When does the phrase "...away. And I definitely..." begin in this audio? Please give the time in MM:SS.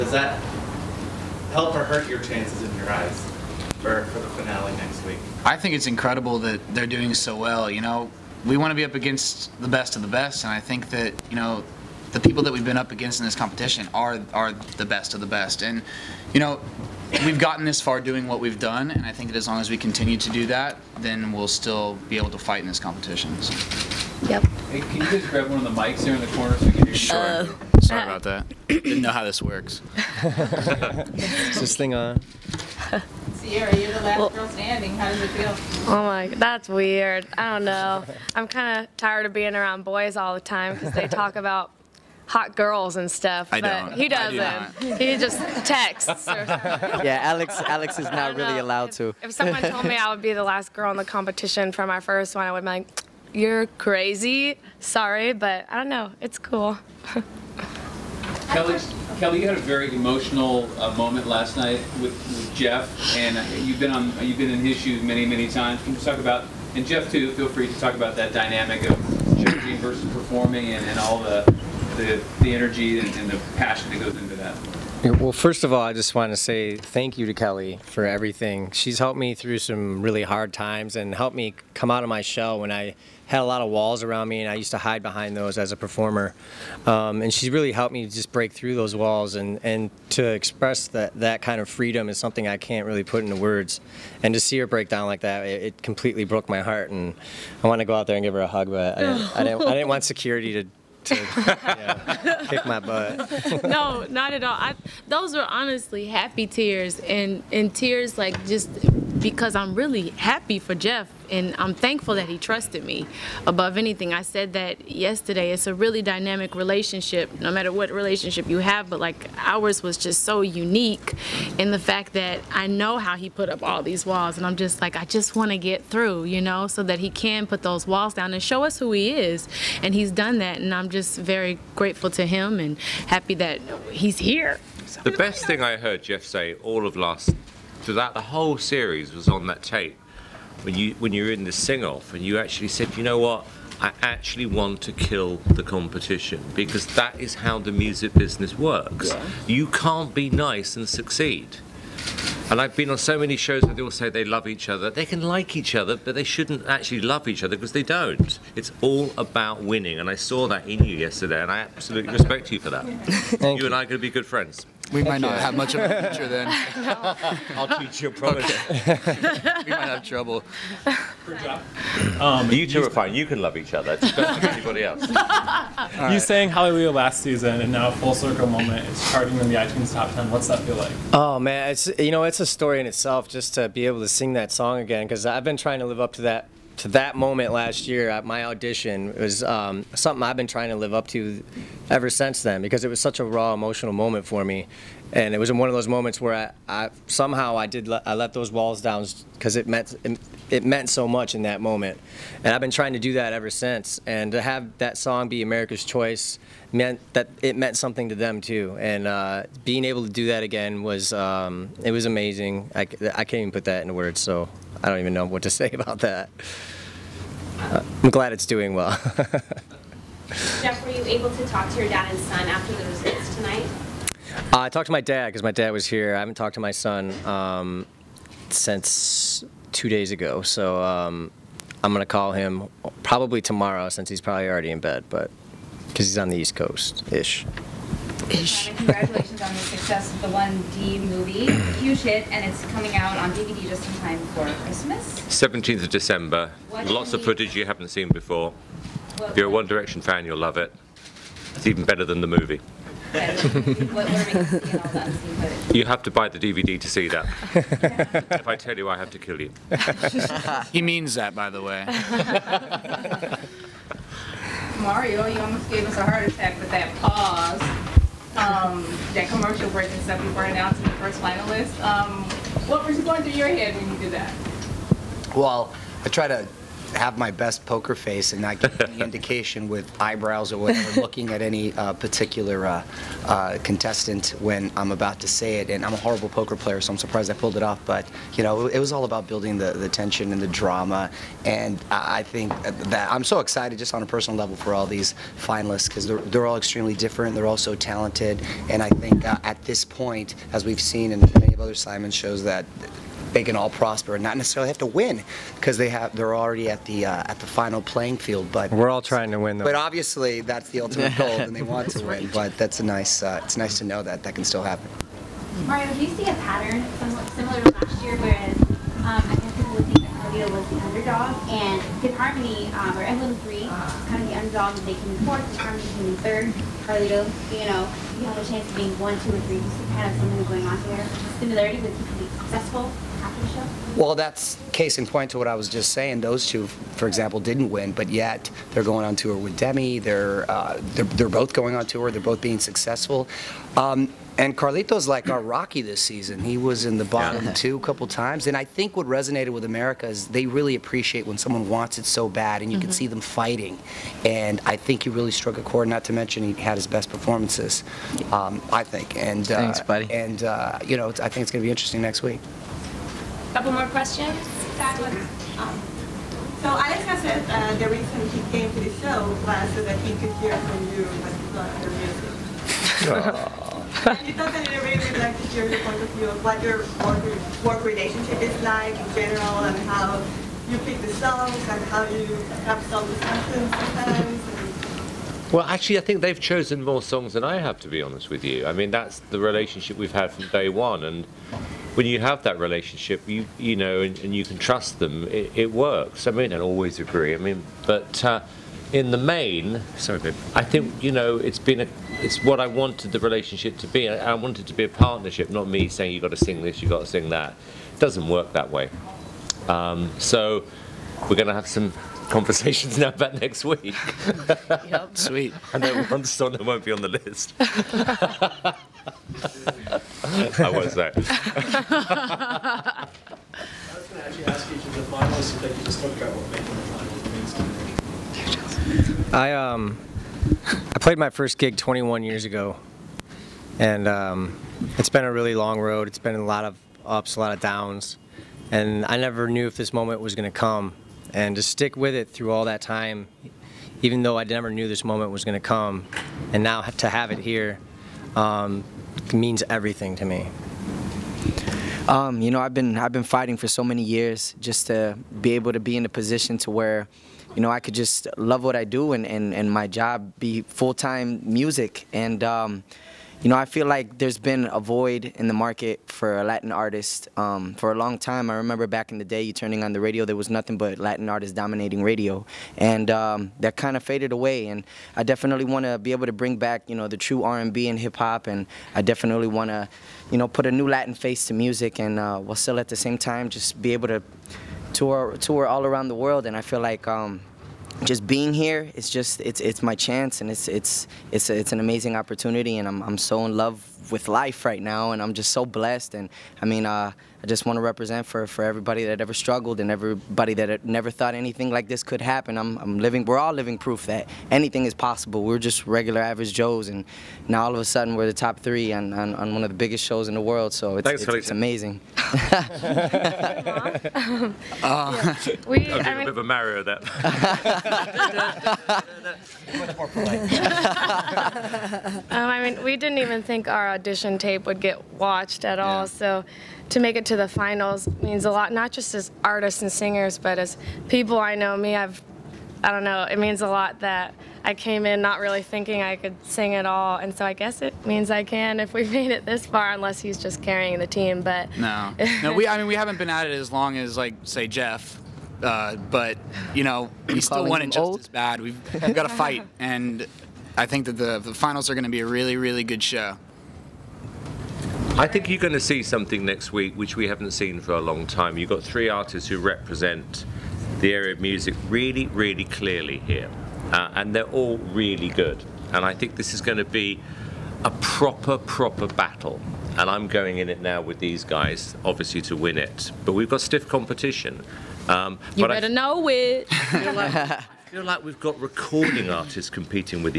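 07:54.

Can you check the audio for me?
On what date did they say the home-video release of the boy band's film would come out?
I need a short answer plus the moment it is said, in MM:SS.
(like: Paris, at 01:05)
17 December, at 04:05.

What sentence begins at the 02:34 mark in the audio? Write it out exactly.
They can like each other, but they shouldn't actually love each other because they don't.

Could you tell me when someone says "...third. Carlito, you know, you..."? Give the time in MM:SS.
05:26.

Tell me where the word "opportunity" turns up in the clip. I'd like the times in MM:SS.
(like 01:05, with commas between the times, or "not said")
08:12.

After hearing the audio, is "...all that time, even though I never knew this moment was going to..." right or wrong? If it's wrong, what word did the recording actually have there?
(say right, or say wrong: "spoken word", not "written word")
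right.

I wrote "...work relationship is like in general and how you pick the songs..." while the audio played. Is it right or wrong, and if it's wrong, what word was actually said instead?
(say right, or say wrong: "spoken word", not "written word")
right.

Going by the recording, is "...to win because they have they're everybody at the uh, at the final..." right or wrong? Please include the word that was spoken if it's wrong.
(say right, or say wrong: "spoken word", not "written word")
wrong: "already", not "everybody".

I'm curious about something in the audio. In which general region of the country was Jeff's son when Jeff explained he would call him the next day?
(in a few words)
East Coast.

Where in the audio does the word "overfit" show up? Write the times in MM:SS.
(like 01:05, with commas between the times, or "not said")
not said.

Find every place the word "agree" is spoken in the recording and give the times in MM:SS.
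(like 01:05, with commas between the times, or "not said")
06:36.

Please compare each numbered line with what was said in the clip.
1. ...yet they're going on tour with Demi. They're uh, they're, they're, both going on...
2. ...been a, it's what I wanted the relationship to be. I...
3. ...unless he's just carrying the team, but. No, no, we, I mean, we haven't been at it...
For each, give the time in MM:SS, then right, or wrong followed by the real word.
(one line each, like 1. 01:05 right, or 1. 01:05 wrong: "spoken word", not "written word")
1. 05:38 right
2. 06:41 right
3. 08:59 right.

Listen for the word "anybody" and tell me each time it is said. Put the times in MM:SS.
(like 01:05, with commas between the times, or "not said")
02:54.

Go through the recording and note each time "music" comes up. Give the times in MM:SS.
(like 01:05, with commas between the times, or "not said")
02:27, 06:13, 07:41, 08:01, 09:21.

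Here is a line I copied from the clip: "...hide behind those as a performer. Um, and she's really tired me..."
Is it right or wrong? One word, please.
wrong.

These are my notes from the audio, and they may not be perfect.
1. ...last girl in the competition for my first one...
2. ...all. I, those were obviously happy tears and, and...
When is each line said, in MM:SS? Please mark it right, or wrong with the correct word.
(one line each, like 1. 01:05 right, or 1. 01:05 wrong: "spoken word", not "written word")
1. 00:50 right
2. 01:44 wrong: "honestly", not "obviously".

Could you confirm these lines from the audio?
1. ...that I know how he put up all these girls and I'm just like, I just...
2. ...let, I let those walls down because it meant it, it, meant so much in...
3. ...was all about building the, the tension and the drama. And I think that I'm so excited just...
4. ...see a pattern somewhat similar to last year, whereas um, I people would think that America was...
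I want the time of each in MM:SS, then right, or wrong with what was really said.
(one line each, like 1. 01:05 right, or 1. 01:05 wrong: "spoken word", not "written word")
1. 02:02 wrong: "walls", not "girls"
2. 03:17 right
3. 04:48 right
4. 05:16 wrong: "Carlito", not "America".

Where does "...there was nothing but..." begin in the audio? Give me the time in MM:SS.
07:50.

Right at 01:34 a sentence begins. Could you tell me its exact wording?
And to see her break down like that, it, it completely broke my heart.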